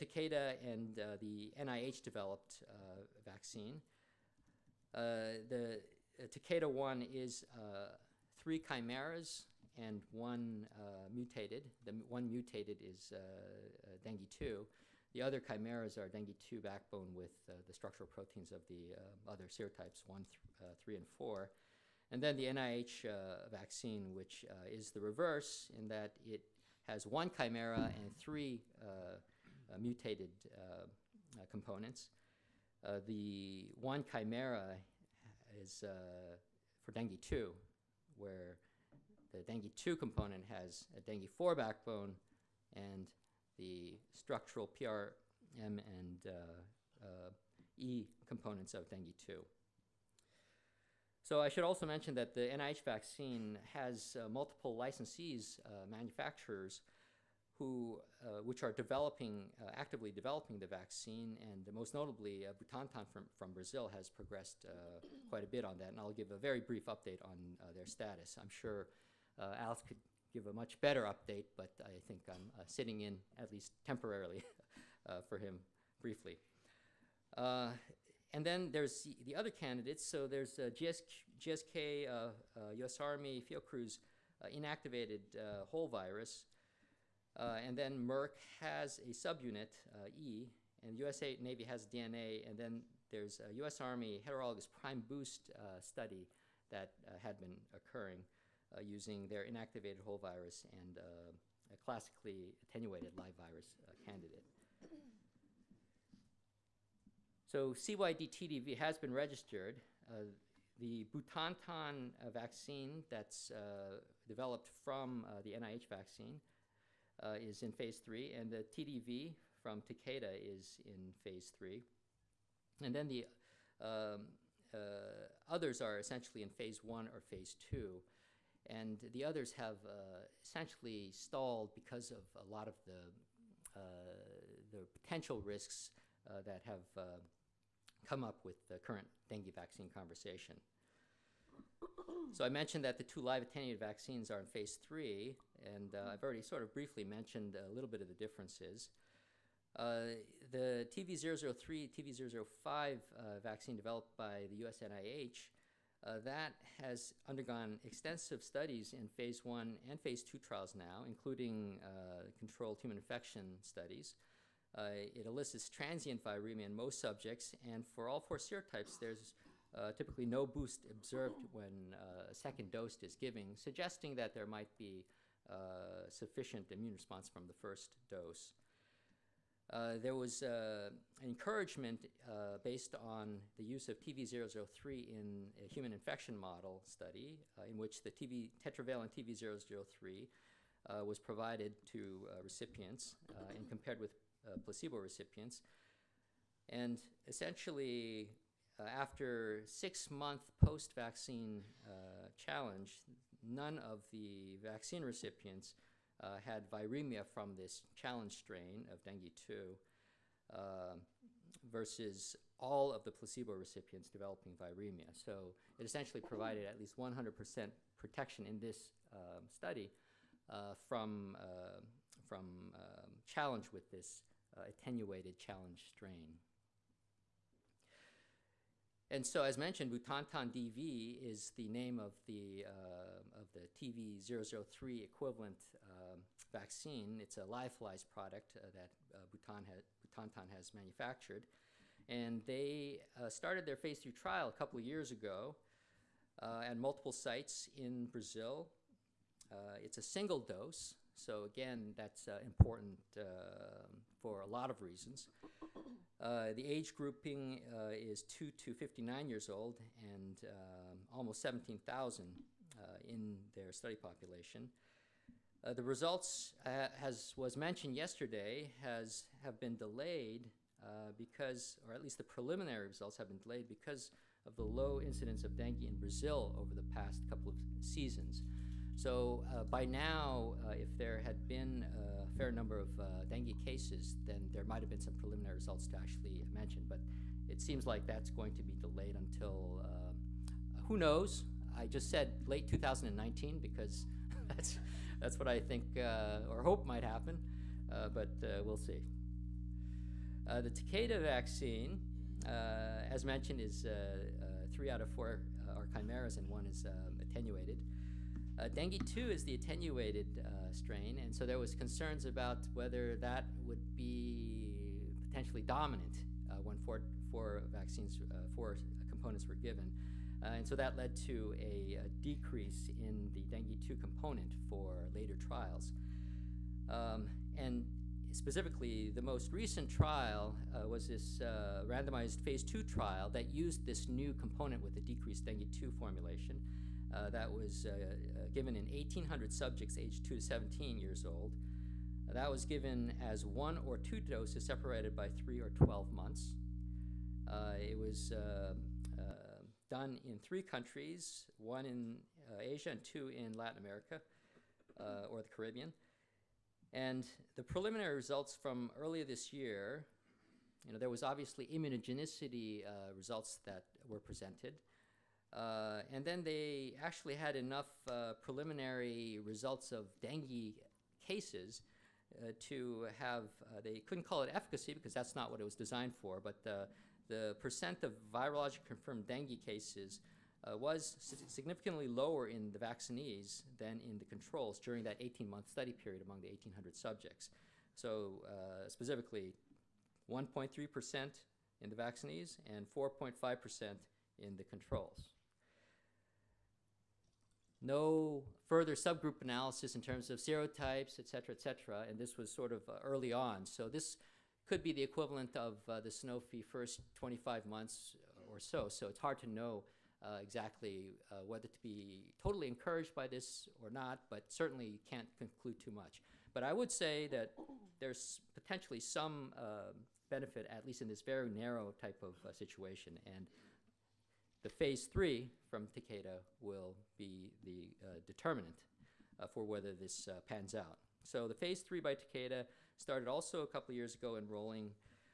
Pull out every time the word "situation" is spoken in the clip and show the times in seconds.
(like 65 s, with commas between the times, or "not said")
422 s.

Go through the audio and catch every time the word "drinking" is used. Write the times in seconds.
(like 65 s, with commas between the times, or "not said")
not said.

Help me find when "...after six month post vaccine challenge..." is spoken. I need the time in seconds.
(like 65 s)
198 s.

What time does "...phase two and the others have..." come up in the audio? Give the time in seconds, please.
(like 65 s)
127 s.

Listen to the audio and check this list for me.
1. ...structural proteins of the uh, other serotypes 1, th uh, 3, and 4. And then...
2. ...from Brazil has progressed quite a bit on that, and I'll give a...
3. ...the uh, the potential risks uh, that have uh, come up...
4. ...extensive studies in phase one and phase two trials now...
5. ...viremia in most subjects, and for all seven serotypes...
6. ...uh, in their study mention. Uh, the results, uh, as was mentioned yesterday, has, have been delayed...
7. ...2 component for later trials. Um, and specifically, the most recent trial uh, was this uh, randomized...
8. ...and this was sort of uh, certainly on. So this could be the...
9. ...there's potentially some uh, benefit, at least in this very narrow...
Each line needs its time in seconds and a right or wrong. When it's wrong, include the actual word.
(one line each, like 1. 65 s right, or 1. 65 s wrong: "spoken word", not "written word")
1. 17 s right
2. 63 s right
3. 132 s right
4. 157 s right
5. 166 s wrong: "four", not "seven"
6. 262 s wrong: "population", not "mention"
7. 323 s right
8. 402 s wrong: "early", not "certainly"
9. 418 s right.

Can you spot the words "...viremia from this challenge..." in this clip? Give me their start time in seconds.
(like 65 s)
206 s.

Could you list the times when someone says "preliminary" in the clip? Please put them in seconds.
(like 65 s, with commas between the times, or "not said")
272 s, 285 s, 357 s, 368 s.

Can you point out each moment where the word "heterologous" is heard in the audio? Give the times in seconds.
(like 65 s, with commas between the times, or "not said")
94 s.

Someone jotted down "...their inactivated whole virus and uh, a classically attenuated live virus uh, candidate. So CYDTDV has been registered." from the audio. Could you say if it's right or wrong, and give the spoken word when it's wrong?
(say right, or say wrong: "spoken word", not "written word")
right.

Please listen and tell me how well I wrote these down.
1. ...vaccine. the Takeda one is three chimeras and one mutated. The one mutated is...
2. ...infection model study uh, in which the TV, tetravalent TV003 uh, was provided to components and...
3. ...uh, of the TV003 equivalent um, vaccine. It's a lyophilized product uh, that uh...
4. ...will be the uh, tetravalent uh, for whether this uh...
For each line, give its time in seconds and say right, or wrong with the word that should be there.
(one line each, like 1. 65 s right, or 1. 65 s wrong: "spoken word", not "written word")
1. 3 s right
2. 185 s wrong: "recipients", not "components"
3. 232 s right
4. 426 s wrong: "determinant", not "tetravalent".